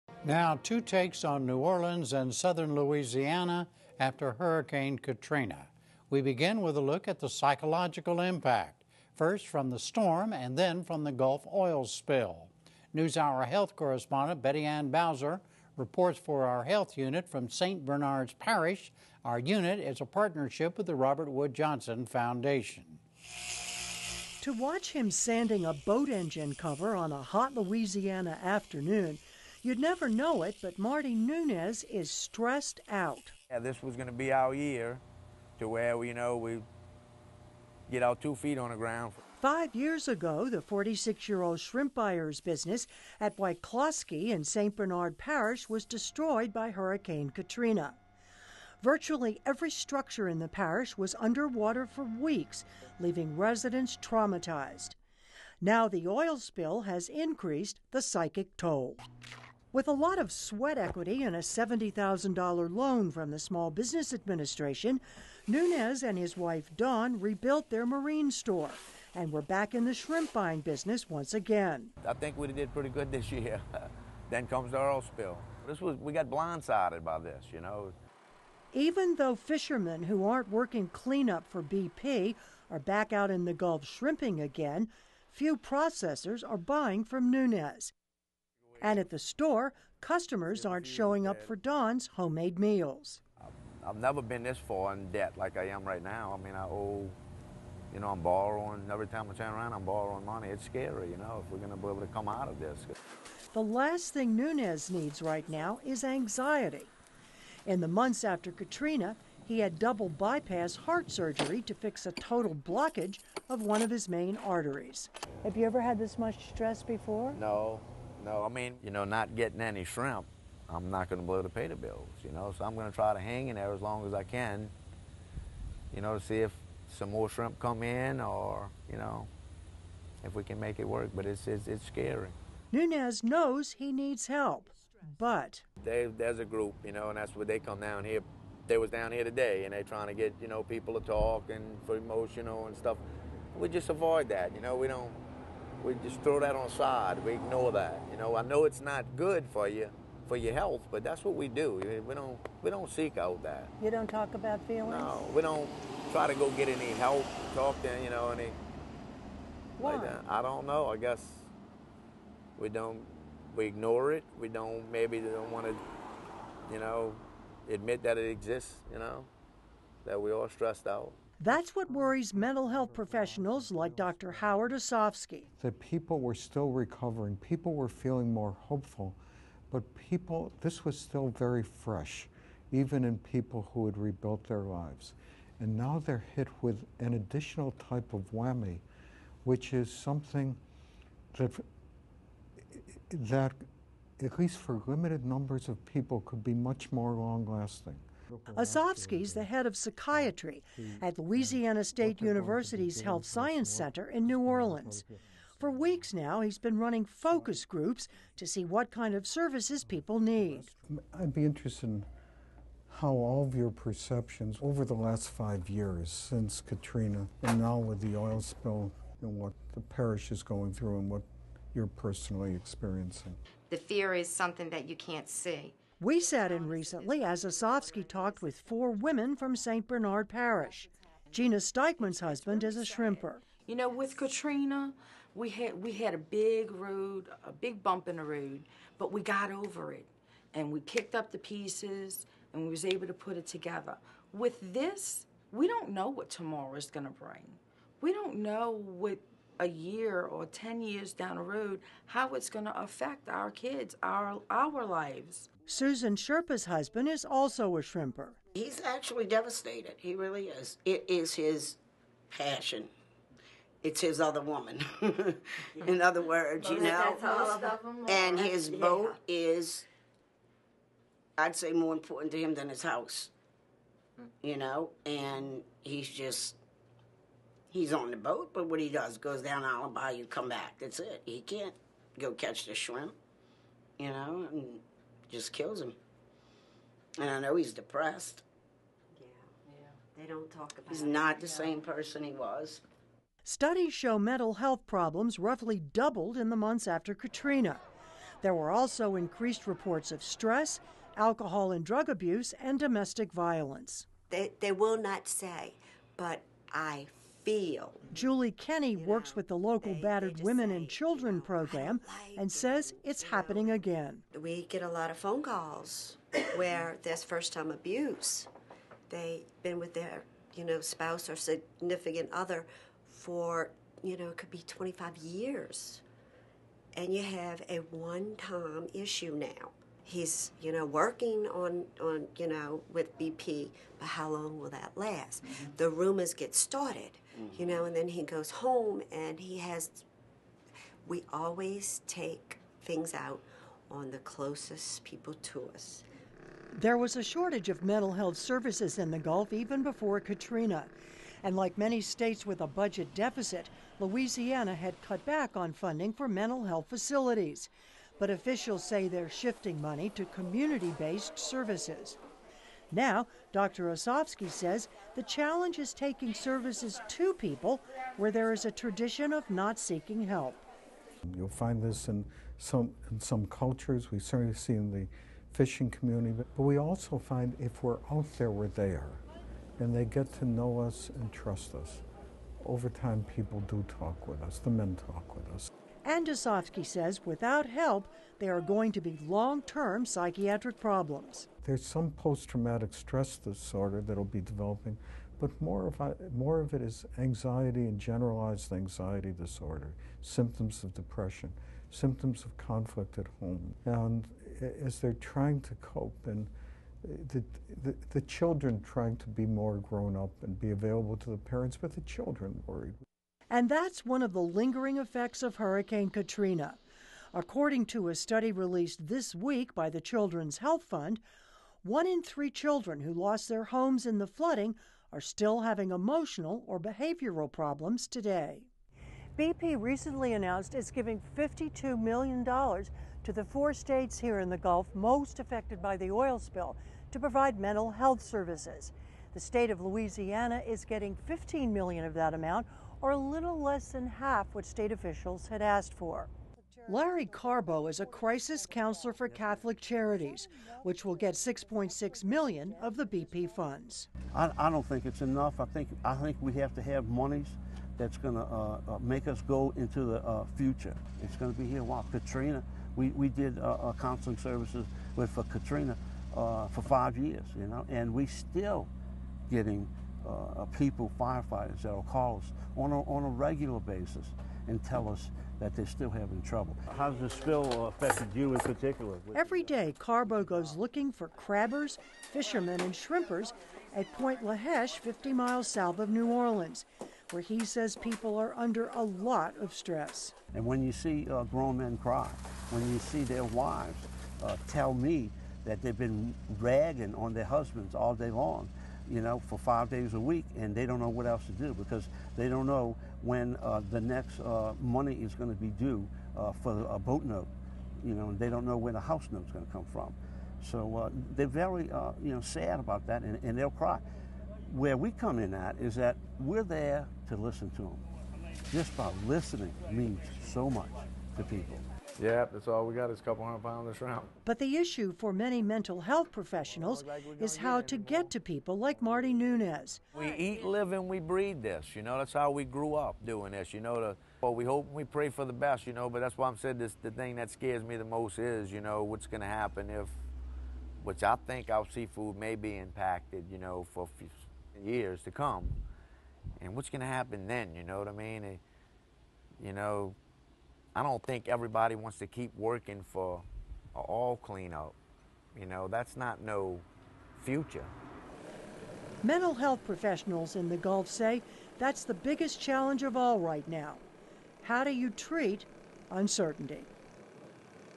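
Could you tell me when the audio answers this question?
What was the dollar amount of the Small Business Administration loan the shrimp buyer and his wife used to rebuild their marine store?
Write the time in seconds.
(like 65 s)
61 s.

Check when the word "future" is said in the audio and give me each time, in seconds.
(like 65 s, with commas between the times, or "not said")
460 s, 557 s.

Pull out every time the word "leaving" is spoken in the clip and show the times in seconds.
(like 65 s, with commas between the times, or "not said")
52 s.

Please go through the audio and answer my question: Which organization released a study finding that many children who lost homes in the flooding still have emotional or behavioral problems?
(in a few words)
Children's Health Fund.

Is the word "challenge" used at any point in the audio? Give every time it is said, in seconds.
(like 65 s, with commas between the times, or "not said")
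365 s, 562 s.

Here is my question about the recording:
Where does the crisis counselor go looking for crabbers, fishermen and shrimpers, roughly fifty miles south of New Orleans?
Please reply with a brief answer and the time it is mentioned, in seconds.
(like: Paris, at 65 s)
Pointe à la Hache, at 484 s.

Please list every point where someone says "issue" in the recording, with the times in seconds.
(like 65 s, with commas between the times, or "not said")
328 s, 524 s.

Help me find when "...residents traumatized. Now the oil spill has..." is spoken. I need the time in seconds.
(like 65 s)
53 s.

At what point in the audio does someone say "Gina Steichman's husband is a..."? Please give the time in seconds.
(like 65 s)
231 s.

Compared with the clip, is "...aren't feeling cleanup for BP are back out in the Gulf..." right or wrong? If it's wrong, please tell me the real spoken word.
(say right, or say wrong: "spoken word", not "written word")
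wrong: "working", not "feeling".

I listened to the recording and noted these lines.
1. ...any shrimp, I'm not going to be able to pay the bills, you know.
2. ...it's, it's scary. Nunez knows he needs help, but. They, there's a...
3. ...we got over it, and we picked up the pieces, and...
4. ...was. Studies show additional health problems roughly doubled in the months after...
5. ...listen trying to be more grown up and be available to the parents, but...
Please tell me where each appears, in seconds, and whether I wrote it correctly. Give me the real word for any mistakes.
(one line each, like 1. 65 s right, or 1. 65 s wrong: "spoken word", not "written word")
1. 119 s right
2. 131 s right
3. 239 s right
4. 292 s wrong: "mental", not "additional"
5. 408 s wrong: "children", not "listen".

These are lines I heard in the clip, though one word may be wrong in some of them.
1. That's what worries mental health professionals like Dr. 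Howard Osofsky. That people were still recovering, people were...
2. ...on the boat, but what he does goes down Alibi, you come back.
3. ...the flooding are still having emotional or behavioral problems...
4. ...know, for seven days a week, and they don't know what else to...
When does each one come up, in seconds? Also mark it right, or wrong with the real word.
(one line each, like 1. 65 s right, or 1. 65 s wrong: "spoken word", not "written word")
1. 171 s right
2. 277 s right
3. 424 s right
4. 499 s wrong: "five", not "seven".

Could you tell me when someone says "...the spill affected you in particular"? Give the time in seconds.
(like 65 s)
477 s.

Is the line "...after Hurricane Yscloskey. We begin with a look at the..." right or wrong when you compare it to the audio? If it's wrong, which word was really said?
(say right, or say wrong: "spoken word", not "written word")
wrong: "Katrina", not "Yscloskey".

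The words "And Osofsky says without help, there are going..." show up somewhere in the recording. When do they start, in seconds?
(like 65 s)
386 s.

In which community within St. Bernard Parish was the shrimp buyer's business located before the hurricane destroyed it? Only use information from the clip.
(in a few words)
Yscloskey.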